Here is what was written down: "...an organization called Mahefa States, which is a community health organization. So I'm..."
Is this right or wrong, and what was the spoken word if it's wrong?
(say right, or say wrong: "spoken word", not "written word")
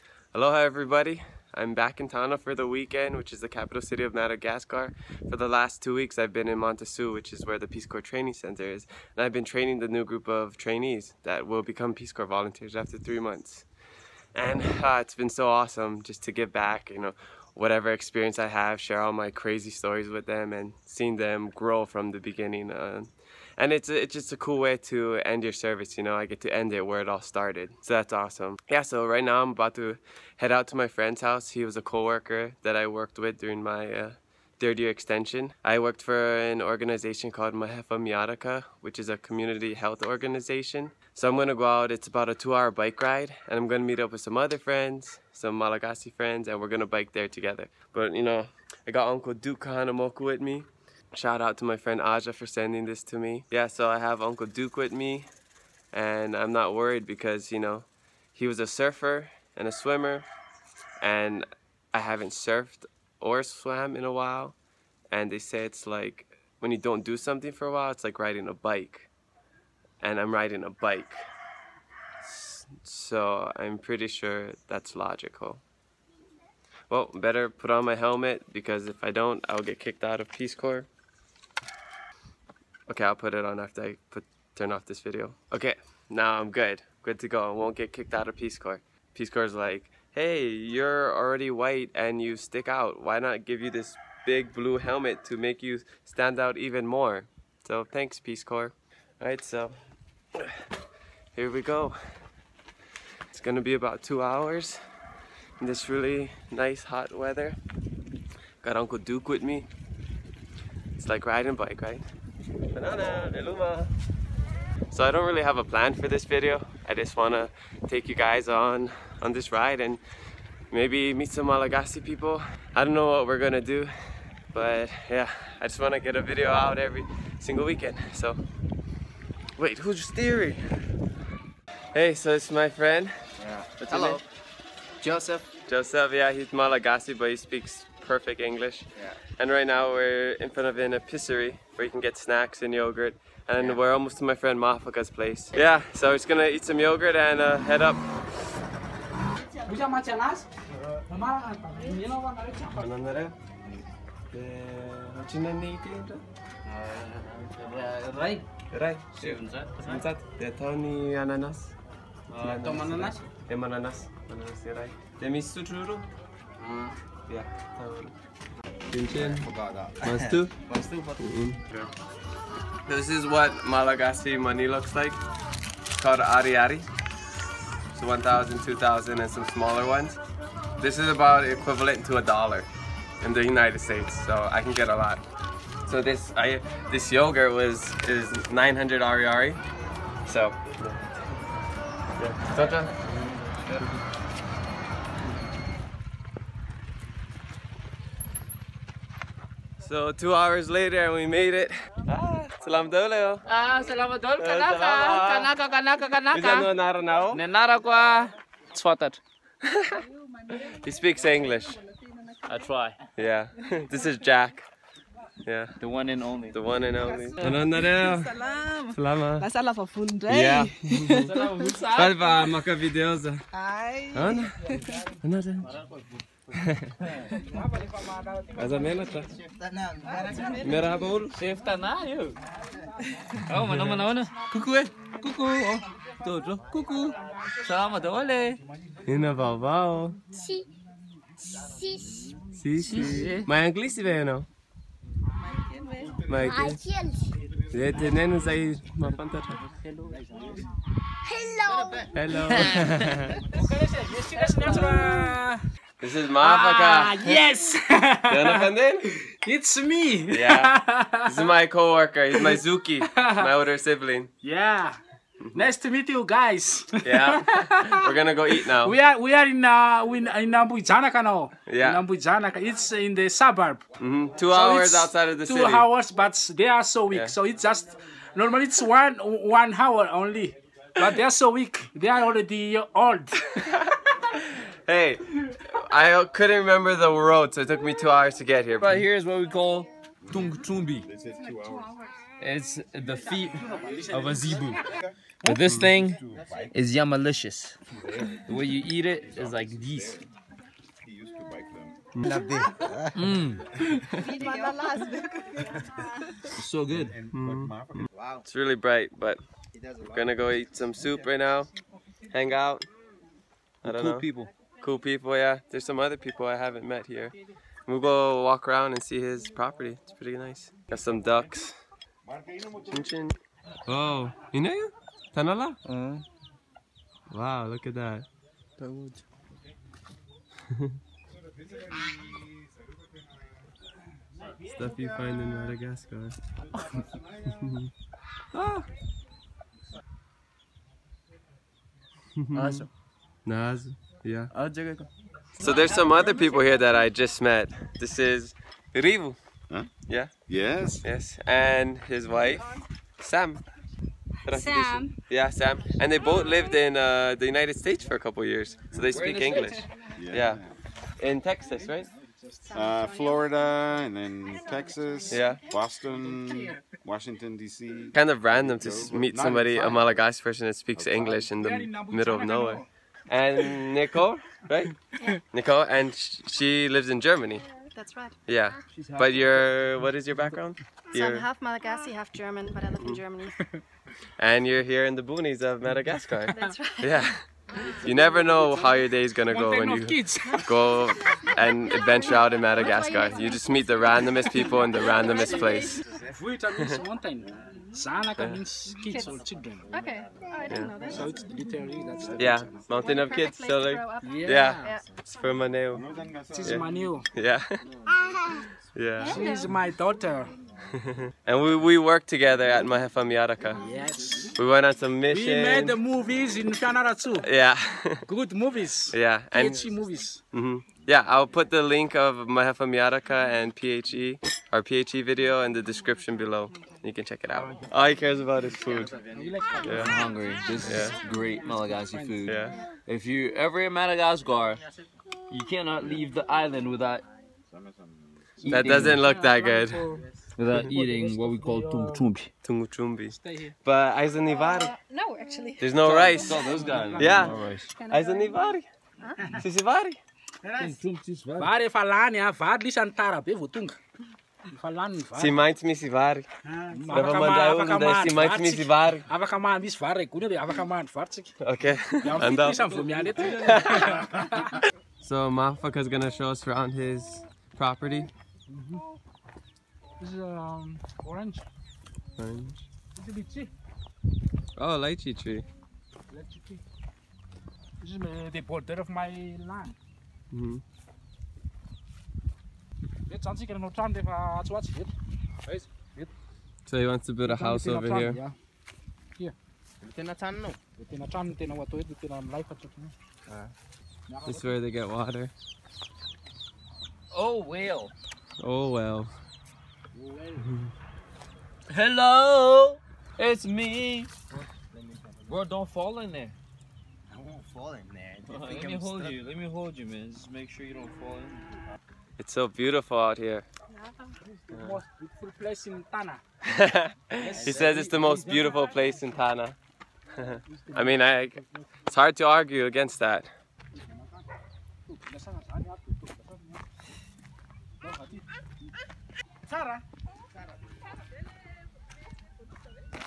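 wrong: "Miaraka", not "States".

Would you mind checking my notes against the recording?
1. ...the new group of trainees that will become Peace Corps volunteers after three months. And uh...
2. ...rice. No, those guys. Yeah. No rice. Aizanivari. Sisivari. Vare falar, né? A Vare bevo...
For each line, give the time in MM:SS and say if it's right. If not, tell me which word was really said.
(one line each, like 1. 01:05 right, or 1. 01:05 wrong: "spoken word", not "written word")
1. 00:09 right
2. 07:26 right.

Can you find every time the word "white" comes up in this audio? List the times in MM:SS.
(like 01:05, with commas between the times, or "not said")
01:31.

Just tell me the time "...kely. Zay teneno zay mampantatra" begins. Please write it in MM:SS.
04:06.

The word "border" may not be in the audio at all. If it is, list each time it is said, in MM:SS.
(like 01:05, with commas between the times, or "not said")
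07:58.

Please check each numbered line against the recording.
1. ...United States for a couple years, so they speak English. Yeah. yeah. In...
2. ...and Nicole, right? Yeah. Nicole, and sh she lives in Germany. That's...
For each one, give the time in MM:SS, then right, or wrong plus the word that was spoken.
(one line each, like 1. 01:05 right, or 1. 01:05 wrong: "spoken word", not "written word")
1. 05:57 right
2. 06:13 right.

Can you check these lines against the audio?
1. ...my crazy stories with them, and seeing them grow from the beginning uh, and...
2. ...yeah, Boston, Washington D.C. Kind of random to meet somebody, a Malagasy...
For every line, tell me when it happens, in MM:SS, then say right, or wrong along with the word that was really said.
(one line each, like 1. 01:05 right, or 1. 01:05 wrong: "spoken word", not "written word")
1. 00:19 right
2. 06:05 right.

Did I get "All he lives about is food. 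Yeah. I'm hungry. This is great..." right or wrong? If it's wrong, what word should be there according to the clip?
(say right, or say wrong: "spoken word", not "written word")
wrong: "cares", not "lives".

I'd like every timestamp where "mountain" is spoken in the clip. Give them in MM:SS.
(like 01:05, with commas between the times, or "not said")
06:42.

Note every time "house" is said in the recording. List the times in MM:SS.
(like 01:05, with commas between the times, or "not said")
00:31, 08:07.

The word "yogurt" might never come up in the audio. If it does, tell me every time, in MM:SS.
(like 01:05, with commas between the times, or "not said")
02:22, 02:26, 03:07.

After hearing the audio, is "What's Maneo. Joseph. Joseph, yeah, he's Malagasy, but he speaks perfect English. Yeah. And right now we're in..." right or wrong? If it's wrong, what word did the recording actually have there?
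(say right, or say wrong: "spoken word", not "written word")
wrong: "Hello", not "Maneo".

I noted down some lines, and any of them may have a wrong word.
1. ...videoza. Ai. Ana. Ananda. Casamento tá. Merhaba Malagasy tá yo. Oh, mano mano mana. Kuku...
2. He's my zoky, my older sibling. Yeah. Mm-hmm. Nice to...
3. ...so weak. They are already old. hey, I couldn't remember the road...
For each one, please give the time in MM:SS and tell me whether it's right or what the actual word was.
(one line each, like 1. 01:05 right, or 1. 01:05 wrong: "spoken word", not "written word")
1. 03:42 wrong: "Seftana", not "Malagasy"
2. 04:22 right
3. 04:41 right.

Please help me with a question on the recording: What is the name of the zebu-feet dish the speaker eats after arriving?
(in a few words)
Tung Chumbi.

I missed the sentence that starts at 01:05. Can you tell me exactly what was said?
And they say it's like, when you don't do something for a while, it's like riding a bike.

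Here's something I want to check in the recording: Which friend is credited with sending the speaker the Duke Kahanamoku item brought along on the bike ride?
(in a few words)
Aja.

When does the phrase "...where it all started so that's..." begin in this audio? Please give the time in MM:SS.
00:26.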